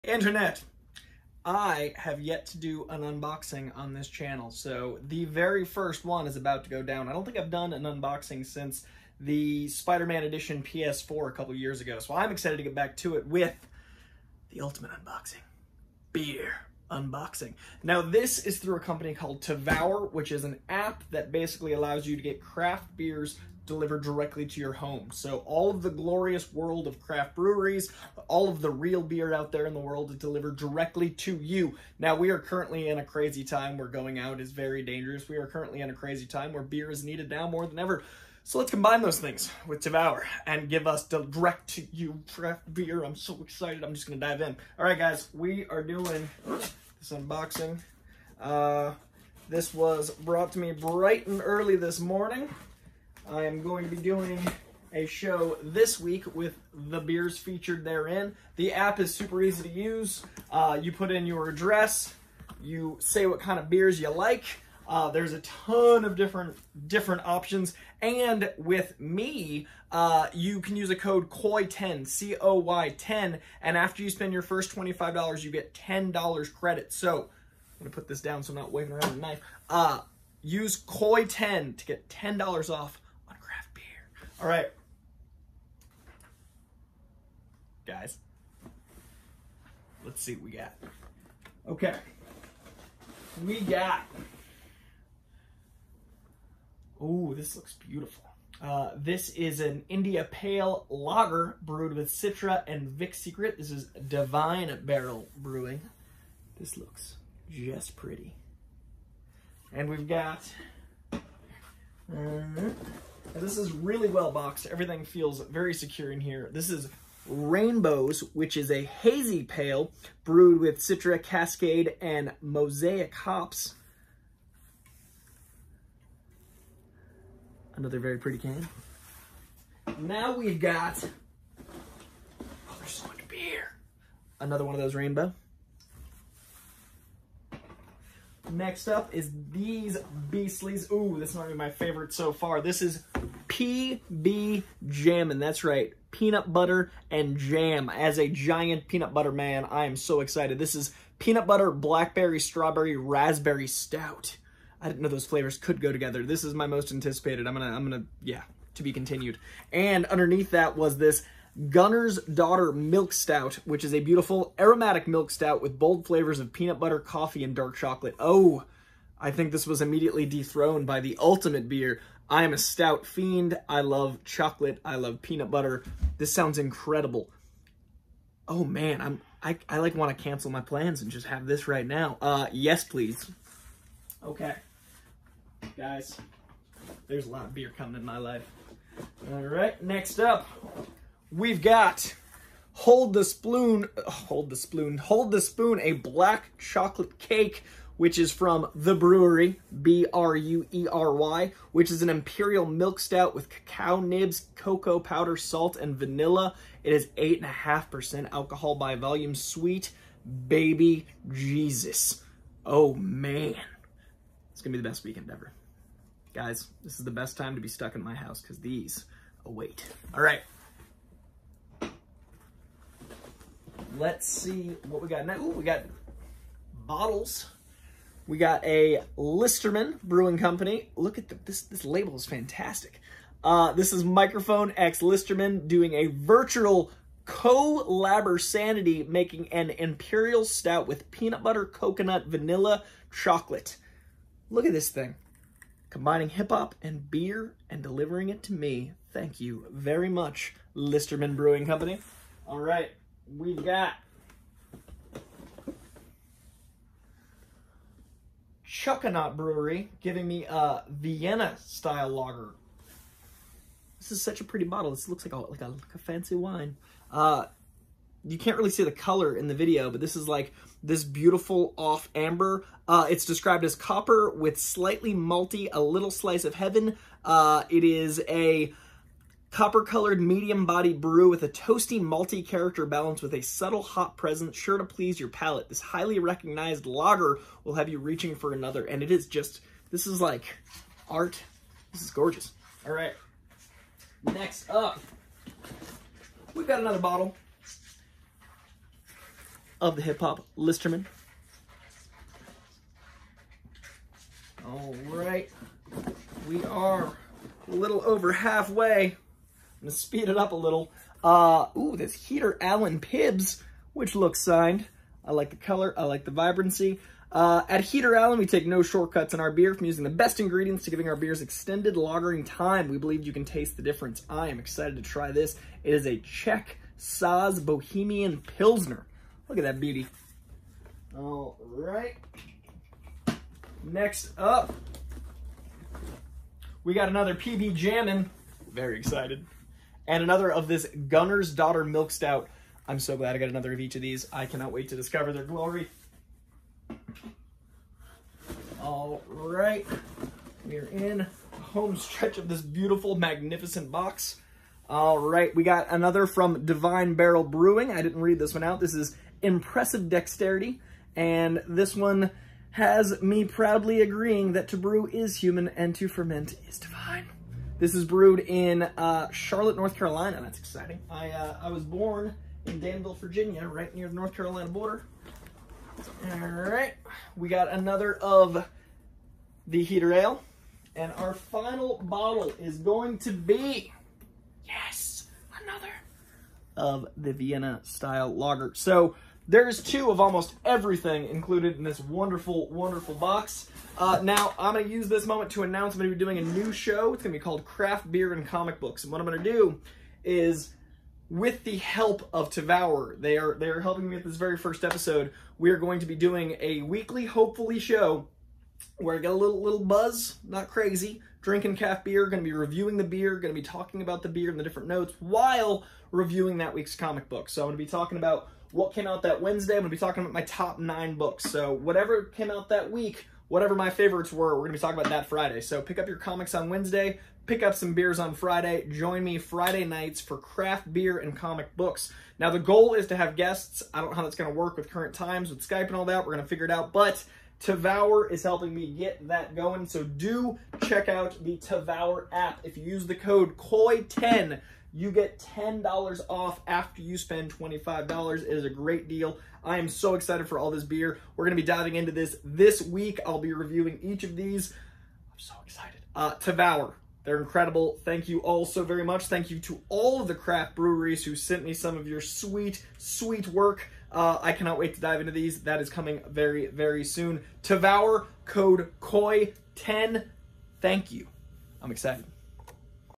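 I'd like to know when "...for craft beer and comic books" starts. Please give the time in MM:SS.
07:10.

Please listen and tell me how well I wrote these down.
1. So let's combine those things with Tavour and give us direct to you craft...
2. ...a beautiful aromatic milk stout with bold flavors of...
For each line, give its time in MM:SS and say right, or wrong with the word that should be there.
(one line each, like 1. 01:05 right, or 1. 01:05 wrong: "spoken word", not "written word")
1. 00:38 right
2. 02:43 right.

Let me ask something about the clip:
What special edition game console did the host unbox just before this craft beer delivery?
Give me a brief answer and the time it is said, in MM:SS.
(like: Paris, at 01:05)
Spider-Man Edition PS4, at 00:09.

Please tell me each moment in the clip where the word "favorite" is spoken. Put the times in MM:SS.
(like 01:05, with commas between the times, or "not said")
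02:21, 07:03.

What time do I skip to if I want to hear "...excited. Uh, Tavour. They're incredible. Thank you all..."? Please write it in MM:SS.
07:35.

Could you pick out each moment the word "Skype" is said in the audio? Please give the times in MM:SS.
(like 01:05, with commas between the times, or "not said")
07:15.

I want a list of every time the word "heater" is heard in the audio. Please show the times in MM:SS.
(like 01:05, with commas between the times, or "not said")
05:12, 05:17, 06:19.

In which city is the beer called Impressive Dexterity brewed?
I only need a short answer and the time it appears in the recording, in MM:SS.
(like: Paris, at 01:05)
Charlotte, at 06:09.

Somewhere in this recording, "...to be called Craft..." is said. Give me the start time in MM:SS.
06:37.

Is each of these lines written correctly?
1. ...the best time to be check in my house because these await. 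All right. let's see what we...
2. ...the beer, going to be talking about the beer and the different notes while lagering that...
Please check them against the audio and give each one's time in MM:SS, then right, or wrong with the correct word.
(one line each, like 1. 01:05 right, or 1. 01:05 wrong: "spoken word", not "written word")
1. 03:37 wrong: "stuck", not "check"
2. 06:52 wrong: "reviewing", not "lagering".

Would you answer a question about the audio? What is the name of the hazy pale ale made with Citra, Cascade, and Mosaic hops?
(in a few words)
Rainbows.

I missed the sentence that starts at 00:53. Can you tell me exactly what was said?
I am going to be doing a show this week with the beers featured therein.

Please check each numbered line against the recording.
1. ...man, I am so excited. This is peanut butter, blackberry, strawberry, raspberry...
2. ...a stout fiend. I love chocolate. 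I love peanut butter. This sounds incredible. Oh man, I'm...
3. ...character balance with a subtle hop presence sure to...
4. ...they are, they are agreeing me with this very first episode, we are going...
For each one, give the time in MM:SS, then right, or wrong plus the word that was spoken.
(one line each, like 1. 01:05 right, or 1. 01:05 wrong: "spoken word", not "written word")
1. 02:29 right
2. 02:52 right
3. 04:42 right
4. 06:43 wrong: "helping", not "agreeing".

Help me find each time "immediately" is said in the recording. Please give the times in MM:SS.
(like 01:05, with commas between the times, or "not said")
02:49.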